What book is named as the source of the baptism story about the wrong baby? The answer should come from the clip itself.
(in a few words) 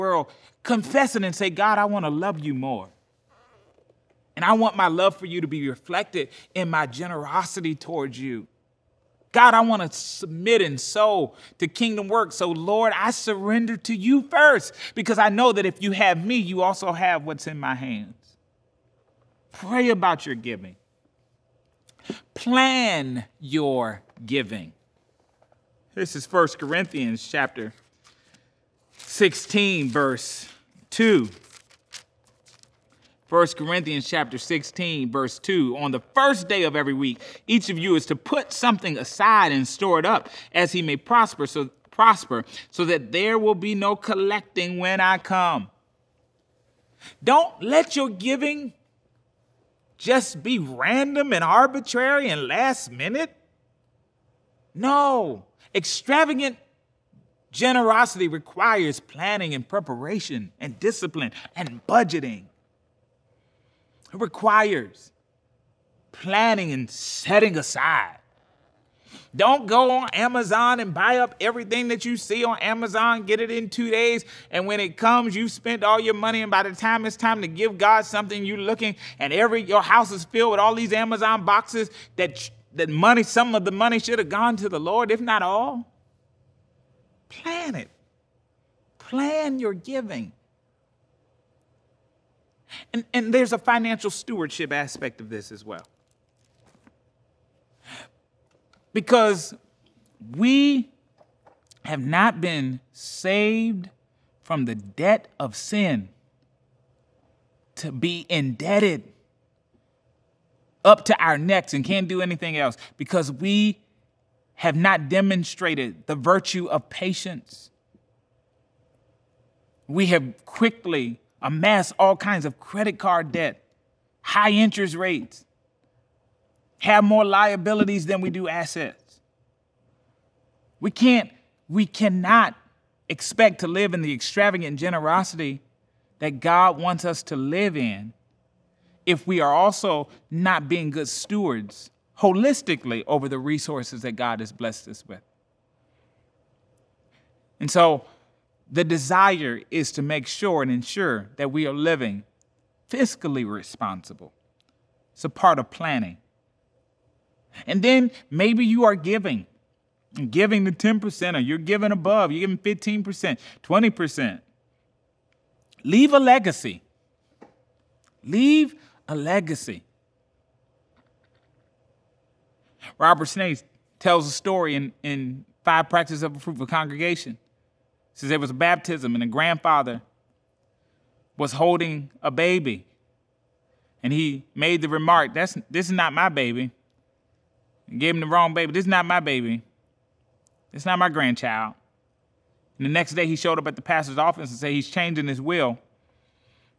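Five Practices of a Fruitful Congregation.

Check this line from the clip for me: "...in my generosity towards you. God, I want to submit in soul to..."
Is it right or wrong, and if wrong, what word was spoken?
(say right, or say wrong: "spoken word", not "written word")
right.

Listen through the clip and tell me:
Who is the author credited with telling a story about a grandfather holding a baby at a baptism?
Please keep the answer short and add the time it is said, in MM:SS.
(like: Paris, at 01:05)
Robert Schnase, at 02:52.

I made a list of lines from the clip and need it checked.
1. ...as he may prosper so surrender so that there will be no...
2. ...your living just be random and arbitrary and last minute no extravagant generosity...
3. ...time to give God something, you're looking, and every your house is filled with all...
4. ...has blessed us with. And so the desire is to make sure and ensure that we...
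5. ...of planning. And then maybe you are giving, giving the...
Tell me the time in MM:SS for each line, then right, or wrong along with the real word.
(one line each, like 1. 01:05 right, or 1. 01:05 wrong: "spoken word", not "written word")
1. 00:40 wrong: "prosper", not "surrender"
2. 00:47 wrong: "giving", not "living"
3. 01:17 right
4. 02:24 right
5. 02:35 right.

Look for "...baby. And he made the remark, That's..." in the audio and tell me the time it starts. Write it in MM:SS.
03:02.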